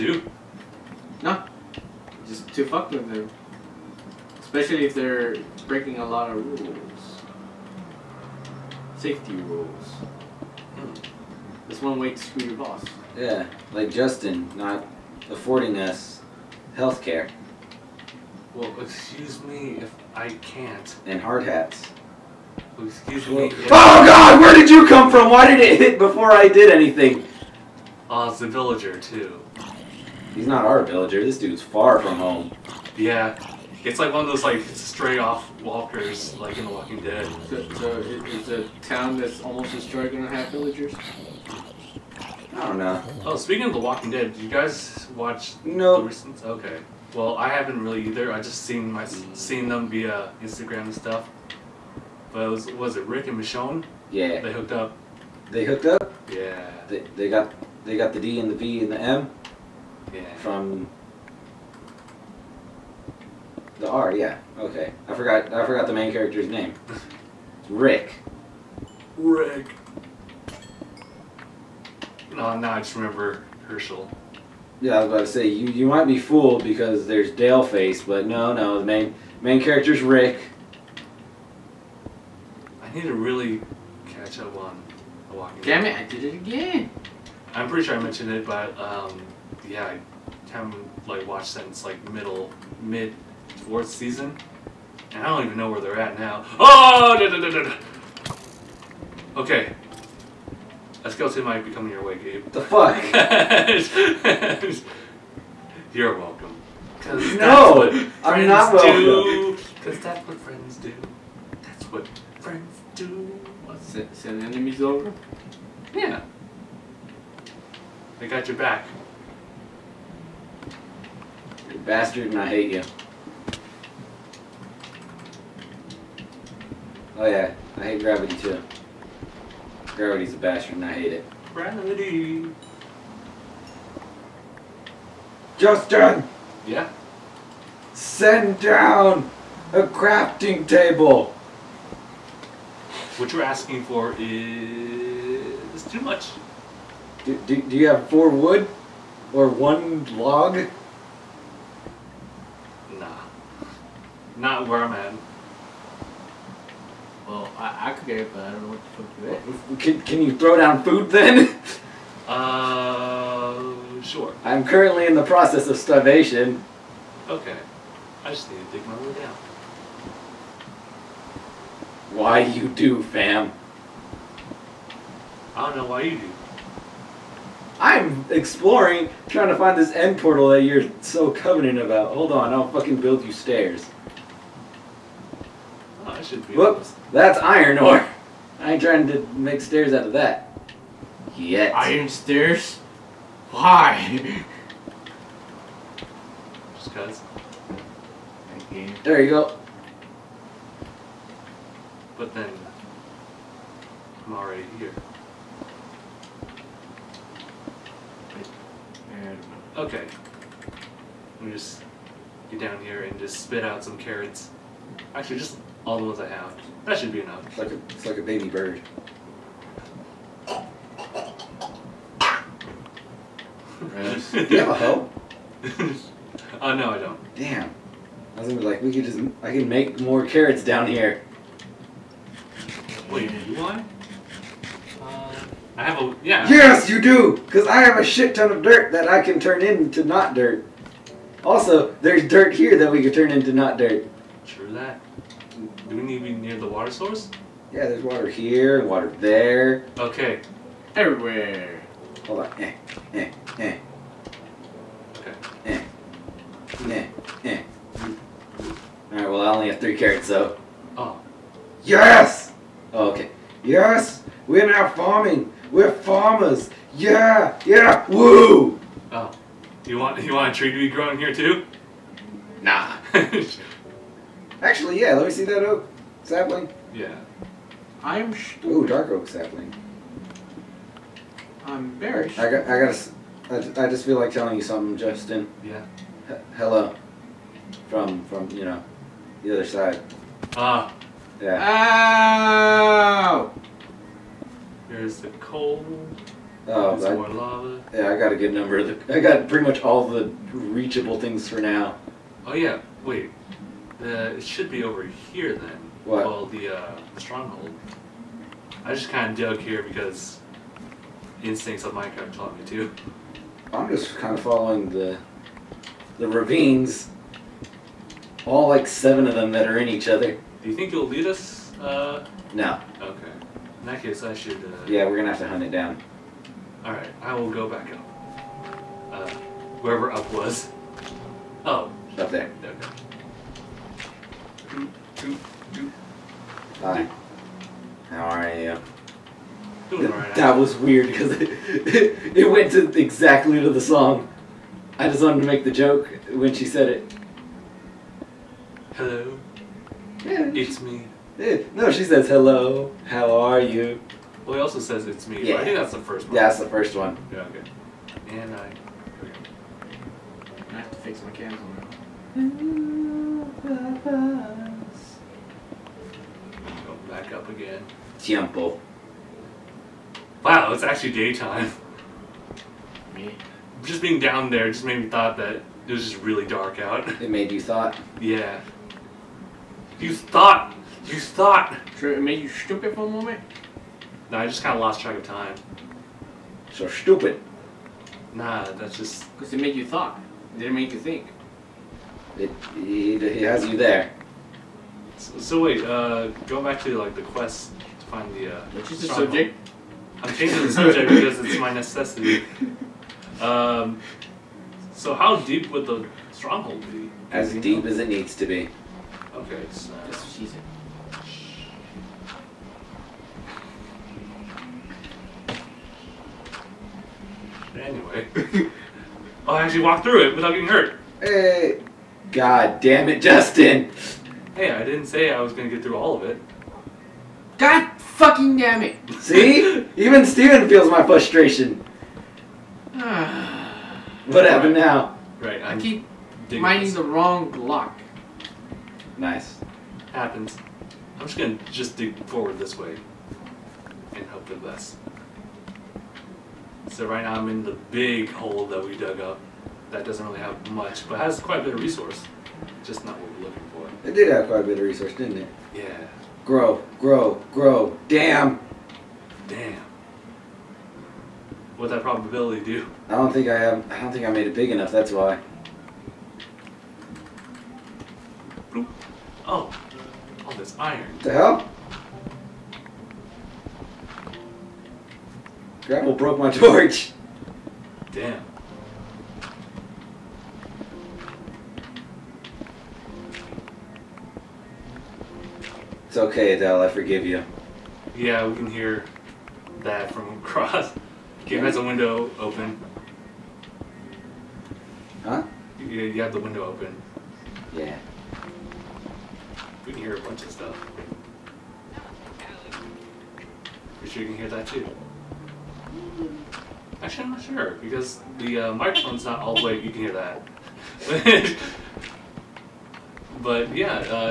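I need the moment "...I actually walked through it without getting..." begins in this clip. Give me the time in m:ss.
6:59.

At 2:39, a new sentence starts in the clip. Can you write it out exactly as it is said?
Can, can you throw down food then?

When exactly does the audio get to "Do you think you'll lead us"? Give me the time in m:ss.
5:20.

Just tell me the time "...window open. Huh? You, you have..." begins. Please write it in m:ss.
8:11.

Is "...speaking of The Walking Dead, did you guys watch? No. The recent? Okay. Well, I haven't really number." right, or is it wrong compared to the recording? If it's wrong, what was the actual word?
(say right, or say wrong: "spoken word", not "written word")
wrong: "either", not "number".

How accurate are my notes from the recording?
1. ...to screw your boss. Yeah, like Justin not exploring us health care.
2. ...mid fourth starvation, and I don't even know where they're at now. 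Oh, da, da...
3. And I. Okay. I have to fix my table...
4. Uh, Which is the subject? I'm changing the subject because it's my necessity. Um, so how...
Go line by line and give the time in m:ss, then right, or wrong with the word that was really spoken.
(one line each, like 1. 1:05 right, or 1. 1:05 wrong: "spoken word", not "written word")
1. 0:12 wrong: "affording", not "exploring"
2. 1:32 wrong: "season", not "starvation"
3. 5:58 wrong: "candle", not "table"
4. 6:38 right.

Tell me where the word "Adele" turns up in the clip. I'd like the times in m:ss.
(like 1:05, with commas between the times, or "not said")
8:06.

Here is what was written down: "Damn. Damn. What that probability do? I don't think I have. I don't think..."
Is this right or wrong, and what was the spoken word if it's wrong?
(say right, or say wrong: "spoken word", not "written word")
right.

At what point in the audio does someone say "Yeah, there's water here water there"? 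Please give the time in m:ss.
4:07.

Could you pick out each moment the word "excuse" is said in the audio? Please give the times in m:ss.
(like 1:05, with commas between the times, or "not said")
0:18, 0:22.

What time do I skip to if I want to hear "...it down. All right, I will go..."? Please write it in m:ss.
5:25.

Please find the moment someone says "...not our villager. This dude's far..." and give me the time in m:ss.
0:30.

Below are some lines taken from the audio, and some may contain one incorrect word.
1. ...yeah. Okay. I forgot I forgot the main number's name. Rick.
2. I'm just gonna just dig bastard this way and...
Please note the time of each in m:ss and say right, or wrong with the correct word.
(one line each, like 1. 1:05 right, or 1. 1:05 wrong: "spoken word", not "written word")
1. 1:04 wrong: "character", not "number"
2. 7:21 wrong: "forward", not "bastard".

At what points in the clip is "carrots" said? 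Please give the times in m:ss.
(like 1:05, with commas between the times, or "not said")
3:33, 3:50, 4:19.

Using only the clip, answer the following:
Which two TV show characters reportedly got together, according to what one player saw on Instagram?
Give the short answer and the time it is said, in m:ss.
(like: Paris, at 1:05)
Rick and Michonne, at 0:53.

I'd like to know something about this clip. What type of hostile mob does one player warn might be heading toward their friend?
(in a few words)
skeleton.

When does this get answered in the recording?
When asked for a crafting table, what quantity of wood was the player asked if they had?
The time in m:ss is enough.
2:28.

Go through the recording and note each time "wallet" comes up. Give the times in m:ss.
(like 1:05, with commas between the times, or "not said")
not said.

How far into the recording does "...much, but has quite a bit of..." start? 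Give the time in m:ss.
7:30.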